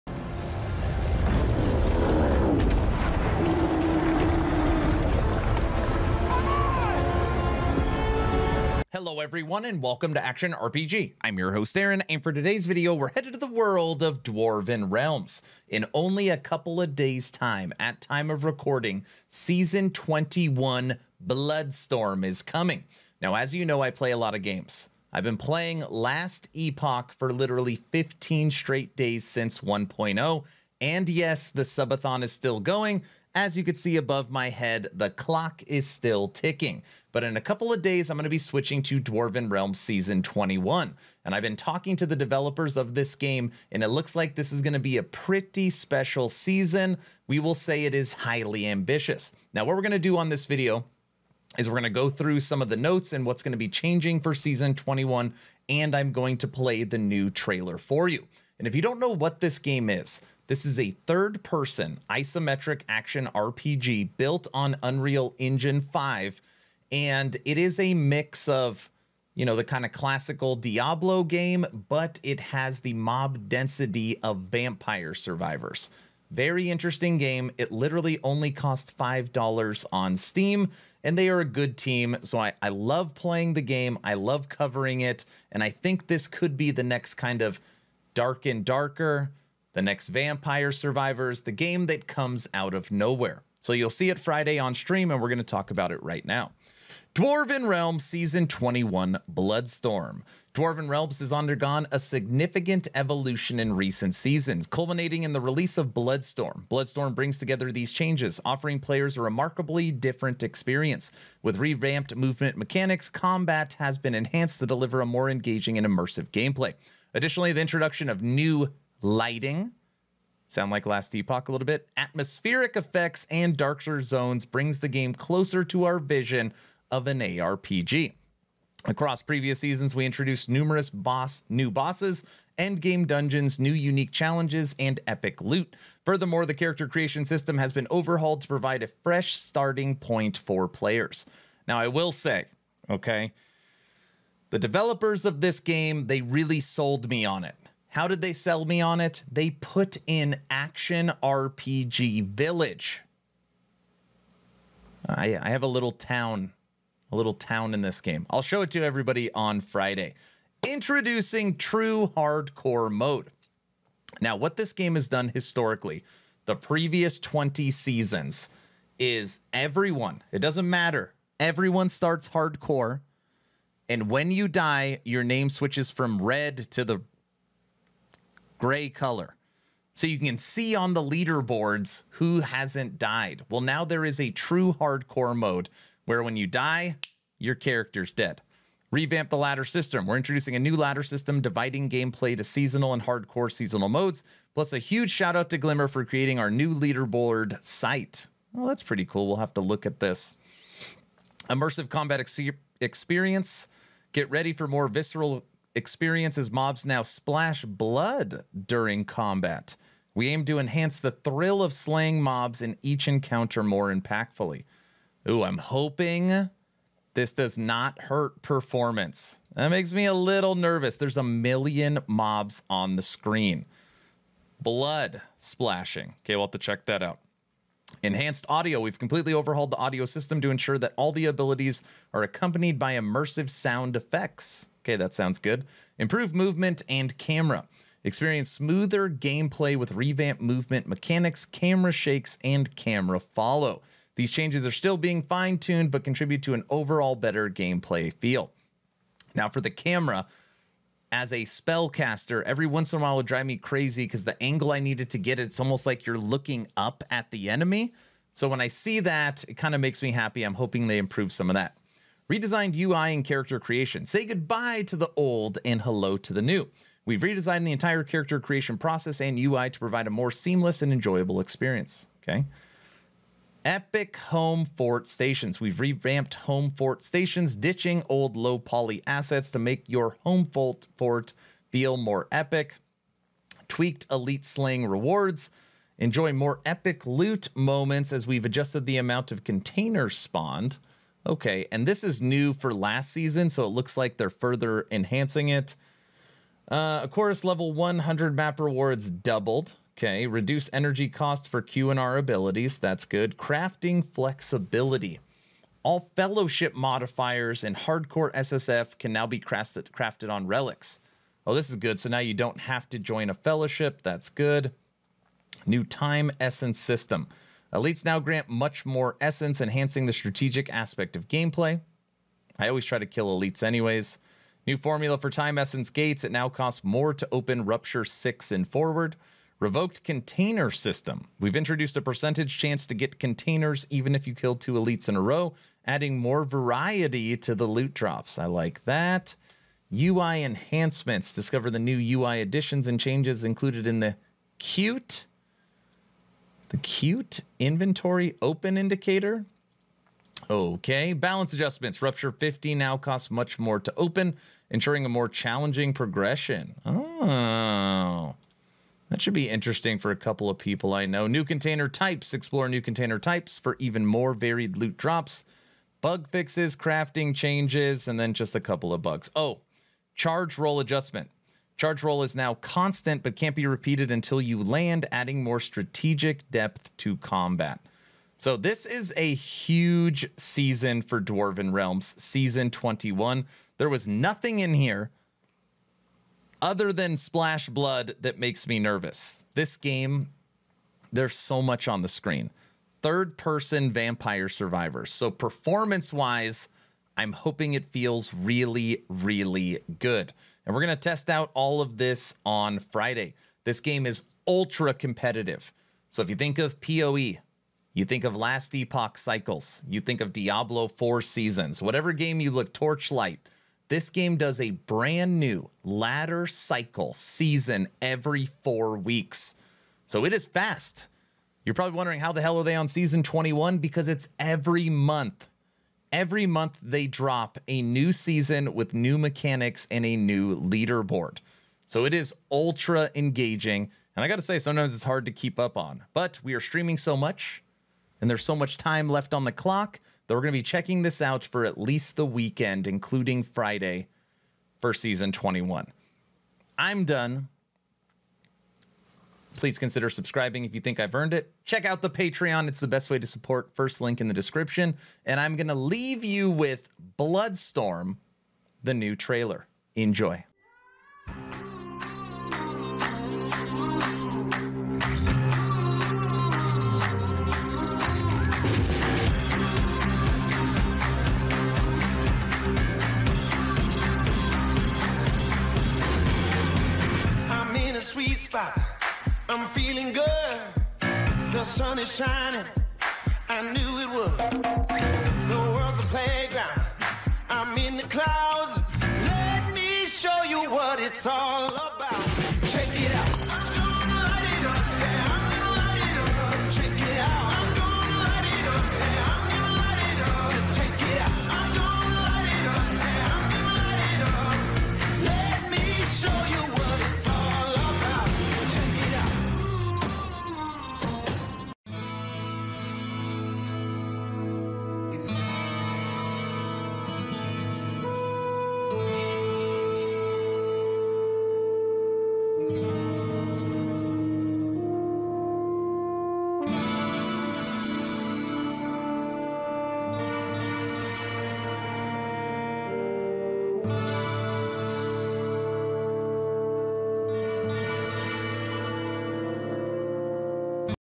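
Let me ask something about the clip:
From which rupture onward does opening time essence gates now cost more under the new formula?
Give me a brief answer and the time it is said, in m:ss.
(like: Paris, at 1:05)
rupture 6, at 5:27.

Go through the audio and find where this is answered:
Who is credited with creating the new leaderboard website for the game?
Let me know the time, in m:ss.
3:15.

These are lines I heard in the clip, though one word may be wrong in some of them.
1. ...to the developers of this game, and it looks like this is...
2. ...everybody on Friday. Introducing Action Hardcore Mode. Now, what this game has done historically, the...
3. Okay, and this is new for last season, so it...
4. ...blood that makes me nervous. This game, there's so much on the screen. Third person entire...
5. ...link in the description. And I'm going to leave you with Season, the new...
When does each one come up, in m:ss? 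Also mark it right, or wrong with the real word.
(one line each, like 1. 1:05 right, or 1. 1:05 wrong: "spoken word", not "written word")
1. 0:41 right
2. 2:38 wrong: "True", not "Action"
3. 4:51 right
4. 6:27 wrong: "vampire", not "entire"
5. 7:33 wrong: "Bloodstorm", not "Season".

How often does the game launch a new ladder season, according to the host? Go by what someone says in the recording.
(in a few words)
every four weeks.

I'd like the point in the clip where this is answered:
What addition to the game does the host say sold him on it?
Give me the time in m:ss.
2:30.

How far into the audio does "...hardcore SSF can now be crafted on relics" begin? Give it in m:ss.
5:07.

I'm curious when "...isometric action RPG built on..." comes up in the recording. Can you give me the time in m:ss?
1:02.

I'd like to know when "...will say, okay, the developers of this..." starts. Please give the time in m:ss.
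2:21.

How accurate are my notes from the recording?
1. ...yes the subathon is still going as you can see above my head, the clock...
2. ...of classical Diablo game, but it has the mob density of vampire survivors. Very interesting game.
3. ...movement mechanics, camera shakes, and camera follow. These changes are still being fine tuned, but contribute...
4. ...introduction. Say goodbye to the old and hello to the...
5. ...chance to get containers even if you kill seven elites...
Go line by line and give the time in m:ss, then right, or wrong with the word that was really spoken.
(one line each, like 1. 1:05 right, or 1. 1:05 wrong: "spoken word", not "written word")
1. 0:31 right
2. 1:09 right
3. 4:00 right
4. 4:23 wrong: "creation", not "introduction"
5. 5:32 wrong: "two", not "seven".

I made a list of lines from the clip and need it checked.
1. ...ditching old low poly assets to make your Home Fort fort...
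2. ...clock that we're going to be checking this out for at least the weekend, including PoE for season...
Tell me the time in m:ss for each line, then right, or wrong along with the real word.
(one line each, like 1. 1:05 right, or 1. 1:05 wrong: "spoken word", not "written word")
1. 4:37 right
2. 7:19 wrong: "Friday", not "PoE".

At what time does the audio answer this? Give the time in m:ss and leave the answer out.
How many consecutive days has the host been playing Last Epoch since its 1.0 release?
0:27.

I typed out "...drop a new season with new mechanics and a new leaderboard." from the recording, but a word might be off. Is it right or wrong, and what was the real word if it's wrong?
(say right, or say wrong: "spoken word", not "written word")
right.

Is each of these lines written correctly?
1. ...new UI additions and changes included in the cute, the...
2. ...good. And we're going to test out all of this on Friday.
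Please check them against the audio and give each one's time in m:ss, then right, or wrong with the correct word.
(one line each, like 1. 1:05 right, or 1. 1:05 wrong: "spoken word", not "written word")
1. 5:41 right
2. 6:39 right.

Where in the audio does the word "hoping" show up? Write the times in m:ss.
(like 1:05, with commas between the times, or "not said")
3:35, 4:20, 6:37.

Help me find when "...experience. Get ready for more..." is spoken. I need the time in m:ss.
3:22.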